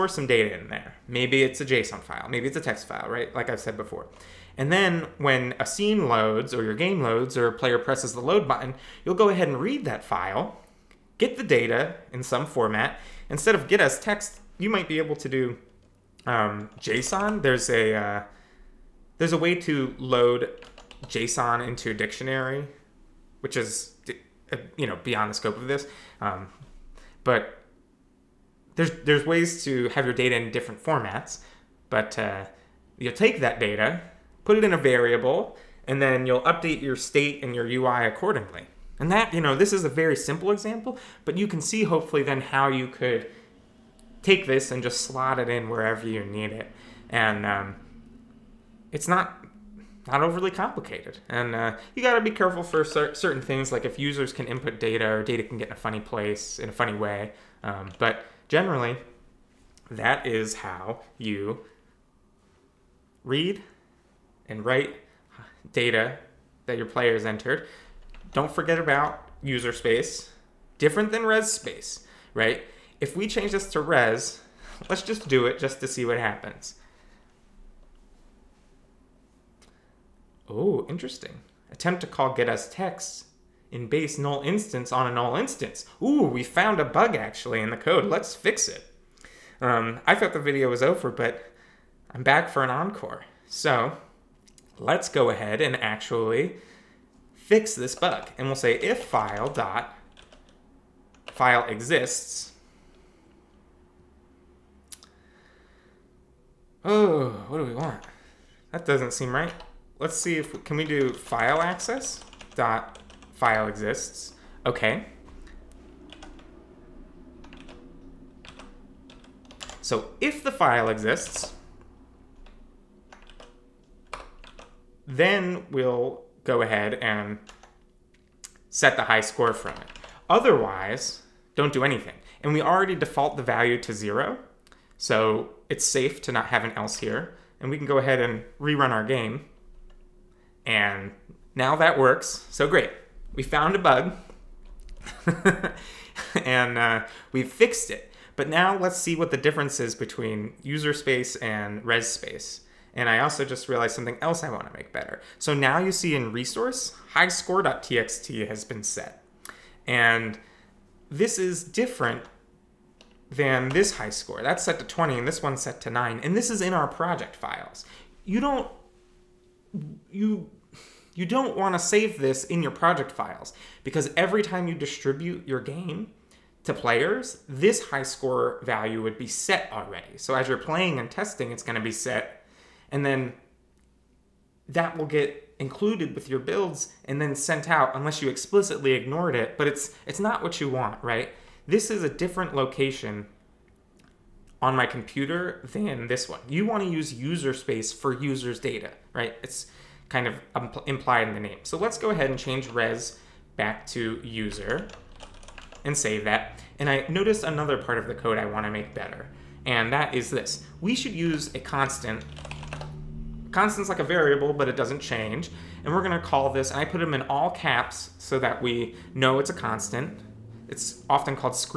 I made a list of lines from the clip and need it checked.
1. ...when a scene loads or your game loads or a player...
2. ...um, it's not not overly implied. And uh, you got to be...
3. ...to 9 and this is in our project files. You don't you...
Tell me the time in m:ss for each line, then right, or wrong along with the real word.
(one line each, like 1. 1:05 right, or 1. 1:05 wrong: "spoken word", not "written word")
1. 0:05 right
2. 0:47 wrong: "complicated", not "implied"
3. 2:45 right.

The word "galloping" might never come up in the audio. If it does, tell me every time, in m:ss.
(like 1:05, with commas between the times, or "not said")
not said.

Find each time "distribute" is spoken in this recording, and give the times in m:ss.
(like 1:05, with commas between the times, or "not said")
2:54.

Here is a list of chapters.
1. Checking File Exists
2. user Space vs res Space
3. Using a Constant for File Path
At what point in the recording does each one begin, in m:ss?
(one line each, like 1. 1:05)
1. 1:12
2. 2:20
3. 3:33.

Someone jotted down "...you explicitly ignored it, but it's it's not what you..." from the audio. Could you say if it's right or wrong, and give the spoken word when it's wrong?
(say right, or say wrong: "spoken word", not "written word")
right.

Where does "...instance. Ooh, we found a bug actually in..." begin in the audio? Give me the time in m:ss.
1:25.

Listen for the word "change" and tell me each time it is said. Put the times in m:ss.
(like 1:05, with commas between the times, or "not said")
1:13, 3:22, 3:34.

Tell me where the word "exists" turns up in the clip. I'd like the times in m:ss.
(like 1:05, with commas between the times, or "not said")
1:41, 1:53, 2:00.